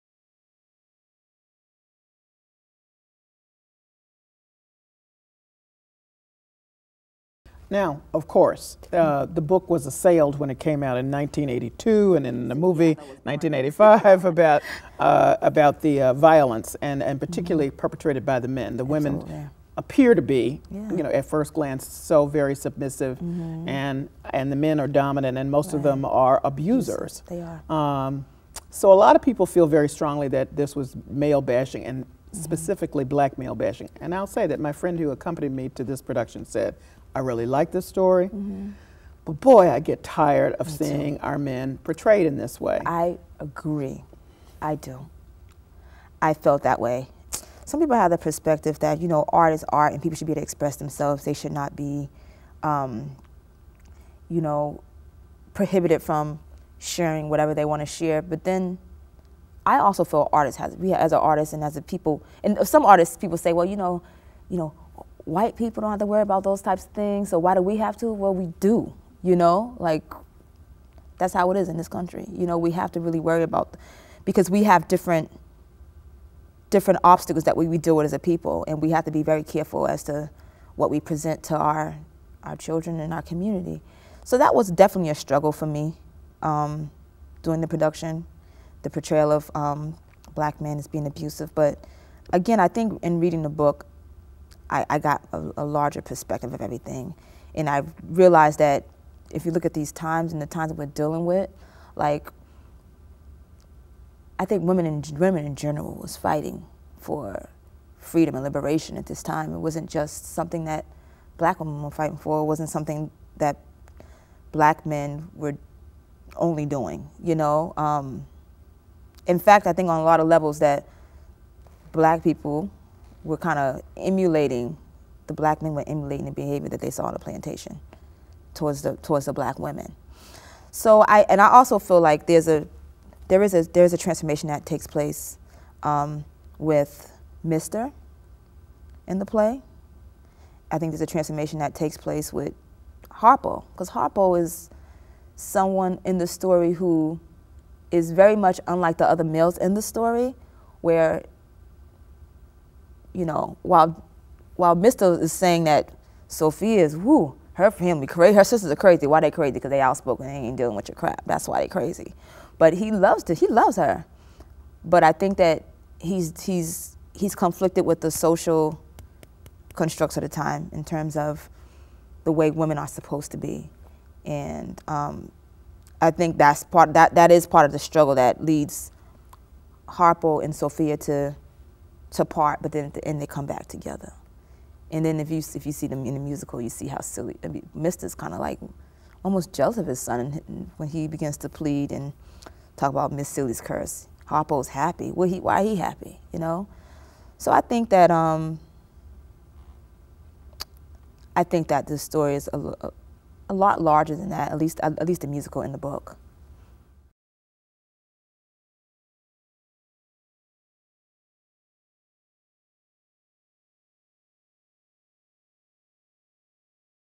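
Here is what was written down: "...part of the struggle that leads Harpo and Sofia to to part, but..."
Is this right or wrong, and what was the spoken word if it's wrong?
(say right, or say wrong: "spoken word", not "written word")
right.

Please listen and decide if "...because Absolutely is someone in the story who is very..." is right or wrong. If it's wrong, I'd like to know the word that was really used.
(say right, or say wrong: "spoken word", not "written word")
wrong: "Harpo", not "Absolutely".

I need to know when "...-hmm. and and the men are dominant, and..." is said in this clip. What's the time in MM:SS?
00:23.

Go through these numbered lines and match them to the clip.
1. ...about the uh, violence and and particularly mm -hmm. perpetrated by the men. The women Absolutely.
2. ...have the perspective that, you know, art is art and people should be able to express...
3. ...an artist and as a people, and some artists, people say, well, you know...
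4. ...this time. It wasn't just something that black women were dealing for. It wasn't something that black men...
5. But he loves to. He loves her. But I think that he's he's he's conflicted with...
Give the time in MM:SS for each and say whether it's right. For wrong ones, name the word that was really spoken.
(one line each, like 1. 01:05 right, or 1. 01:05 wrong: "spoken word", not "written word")
1. 00:15 right
2. 00:47 right
3. 01:01 right
4. 01:49 wrong: "fighting", not "dealing"
5. 02:42 right.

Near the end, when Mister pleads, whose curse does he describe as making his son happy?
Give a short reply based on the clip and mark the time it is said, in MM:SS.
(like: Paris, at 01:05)
Miss Celie, at 03:13.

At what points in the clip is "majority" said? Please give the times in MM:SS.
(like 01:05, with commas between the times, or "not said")
not said.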